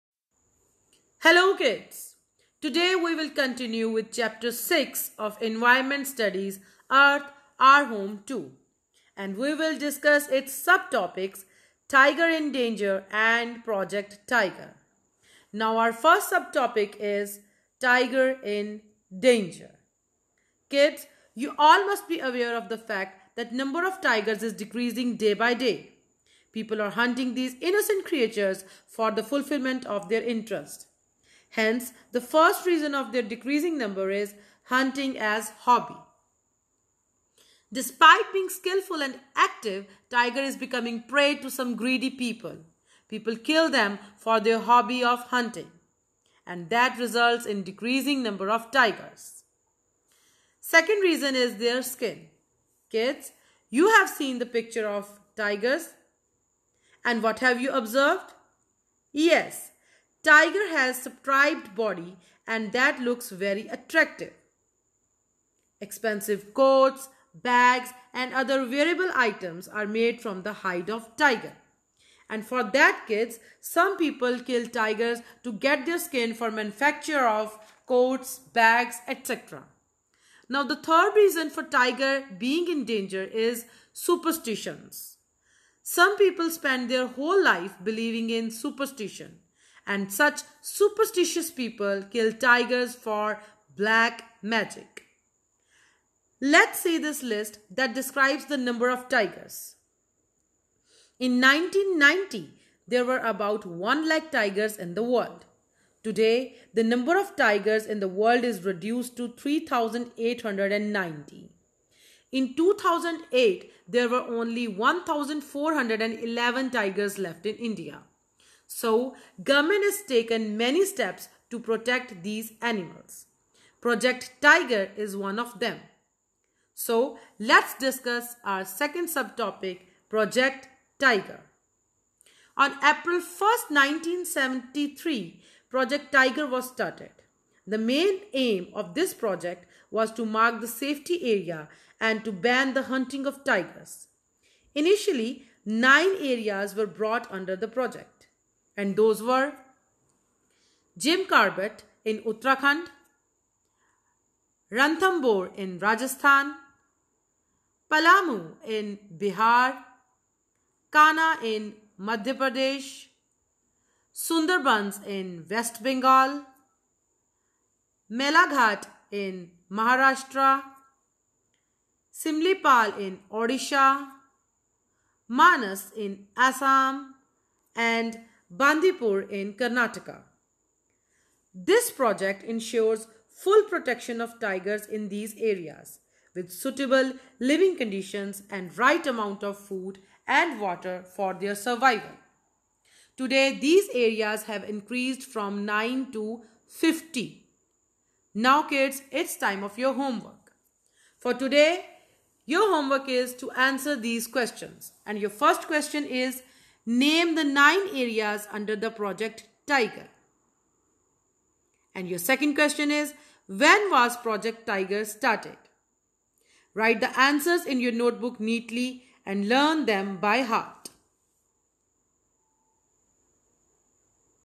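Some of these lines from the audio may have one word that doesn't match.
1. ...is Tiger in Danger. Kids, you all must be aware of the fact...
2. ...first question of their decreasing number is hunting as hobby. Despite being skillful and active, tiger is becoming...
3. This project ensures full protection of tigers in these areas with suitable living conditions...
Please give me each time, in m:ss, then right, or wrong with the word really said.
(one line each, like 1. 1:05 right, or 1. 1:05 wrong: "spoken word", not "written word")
1. 0:16 right
2. 0:32 wrong: "reason", not "question"
3. 3:01 right.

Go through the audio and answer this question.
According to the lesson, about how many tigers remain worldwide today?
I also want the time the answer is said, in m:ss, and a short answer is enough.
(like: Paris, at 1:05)
3,890, at 1:49.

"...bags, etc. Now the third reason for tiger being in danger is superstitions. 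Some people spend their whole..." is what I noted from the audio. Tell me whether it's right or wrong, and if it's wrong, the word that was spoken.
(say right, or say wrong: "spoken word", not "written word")
right.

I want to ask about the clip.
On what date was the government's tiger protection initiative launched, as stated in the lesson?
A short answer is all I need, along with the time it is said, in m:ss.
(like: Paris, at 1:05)
April 1st, 1973, at 2:12.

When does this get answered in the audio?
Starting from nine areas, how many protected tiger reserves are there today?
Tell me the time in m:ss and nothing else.
3:16.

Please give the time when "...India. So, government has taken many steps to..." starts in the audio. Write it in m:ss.
1:57.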